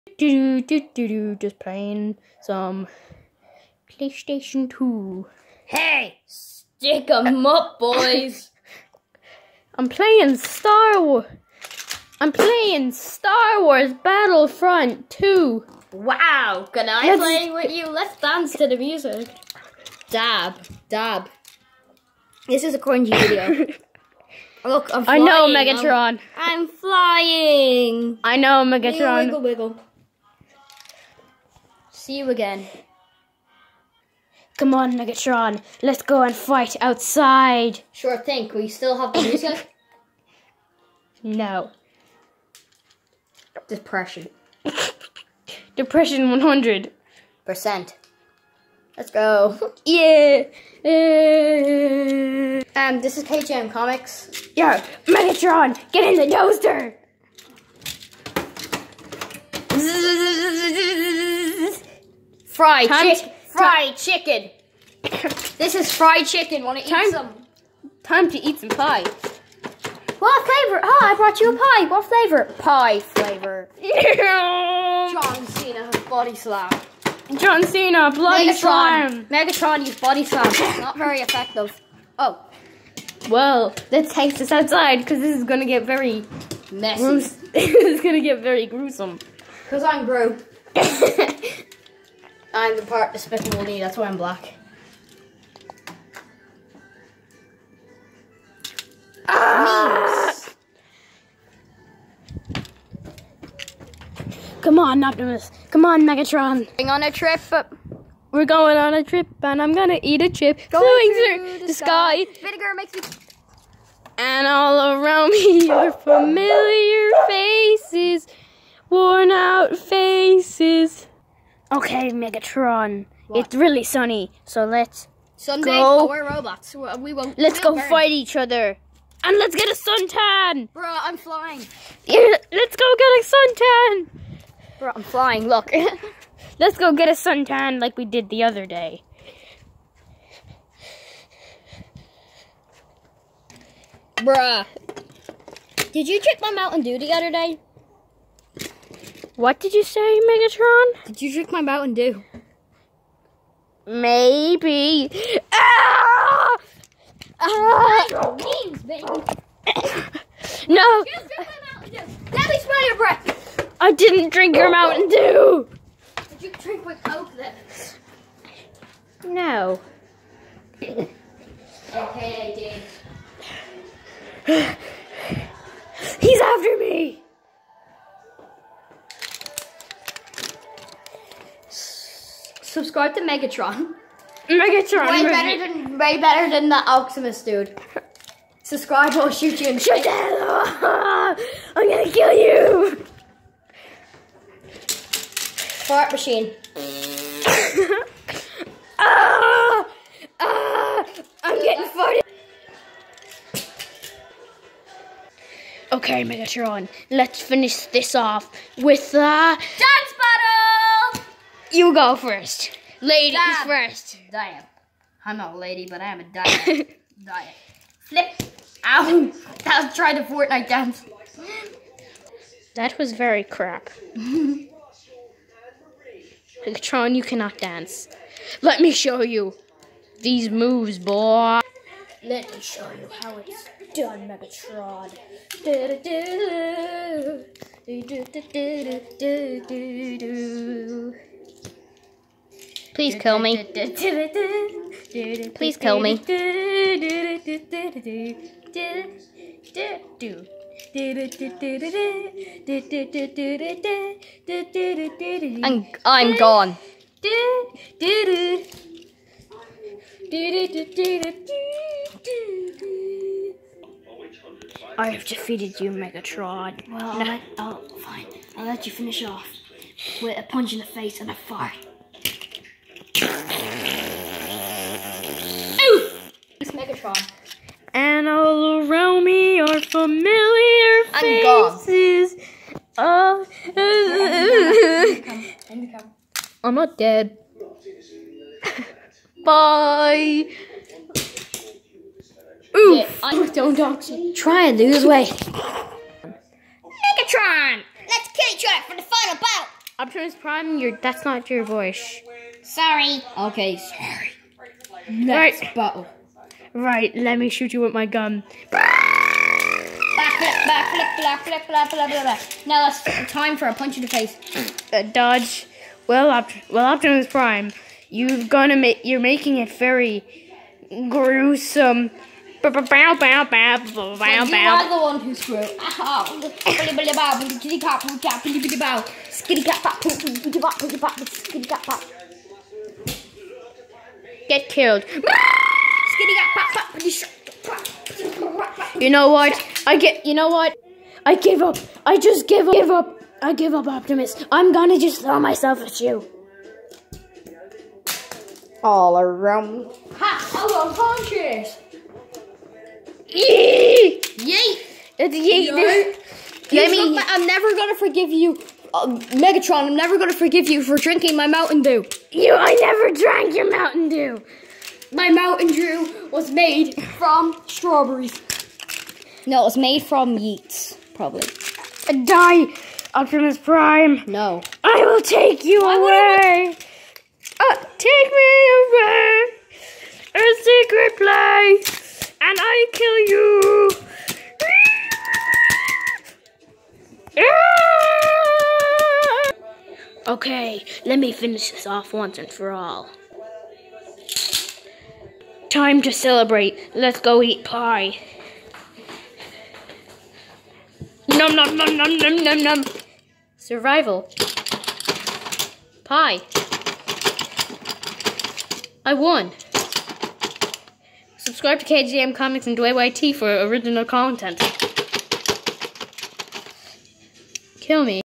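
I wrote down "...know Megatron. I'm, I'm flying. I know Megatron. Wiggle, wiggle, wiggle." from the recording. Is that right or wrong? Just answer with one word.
right.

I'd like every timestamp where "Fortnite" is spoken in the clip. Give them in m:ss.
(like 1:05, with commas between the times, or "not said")
3:40.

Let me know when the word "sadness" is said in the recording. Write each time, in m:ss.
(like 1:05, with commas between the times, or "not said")
not said.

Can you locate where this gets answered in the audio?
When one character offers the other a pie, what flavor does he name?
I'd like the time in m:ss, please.
1:12.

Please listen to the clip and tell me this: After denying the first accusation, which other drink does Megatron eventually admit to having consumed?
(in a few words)
Coke.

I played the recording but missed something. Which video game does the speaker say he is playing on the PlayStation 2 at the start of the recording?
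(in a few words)
Star Wars Battlefront 2.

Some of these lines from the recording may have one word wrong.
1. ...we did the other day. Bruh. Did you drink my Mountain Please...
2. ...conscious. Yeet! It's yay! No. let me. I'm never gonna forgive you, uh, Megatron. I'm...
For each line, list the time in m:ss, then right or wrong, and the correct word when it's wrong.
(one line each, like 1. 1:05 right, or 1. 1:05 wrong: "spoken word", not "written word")
1. 2:17 wrong: "Dew", not "Please"
2. 5:50 right.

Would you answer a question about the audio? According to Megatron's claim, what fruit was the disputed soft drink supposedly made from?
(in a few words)
Strawberries.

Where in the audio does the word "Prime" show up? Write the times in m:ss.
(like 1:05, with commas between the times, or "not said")
5:00, 5:17, 6:13.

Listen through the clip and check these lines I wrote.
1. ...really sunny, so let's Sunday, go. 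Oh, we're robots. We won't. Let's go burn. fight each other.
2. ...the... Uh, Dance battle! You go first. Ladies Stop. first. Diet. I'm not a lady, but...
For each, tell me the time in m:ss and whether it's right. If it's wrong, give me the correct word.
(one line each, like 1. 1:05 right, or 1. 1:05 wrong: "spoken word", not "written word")
1. 2:03 right
2. 3:29 right.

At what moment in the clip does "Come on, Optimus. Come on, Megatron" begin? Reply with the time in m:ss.
1:44.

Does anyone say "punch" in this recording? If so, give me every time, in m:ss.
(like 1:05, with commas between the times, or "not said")
4:30, 5:13.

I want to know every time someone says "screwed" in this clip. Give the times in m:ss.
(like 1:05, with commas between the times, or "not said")
5:25.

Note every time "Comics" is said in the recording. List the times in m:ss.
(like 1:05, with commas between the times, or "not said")
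0:53, 6:52.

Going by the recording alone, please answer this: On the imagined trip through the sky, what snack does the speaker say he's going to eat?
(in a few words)
A chip.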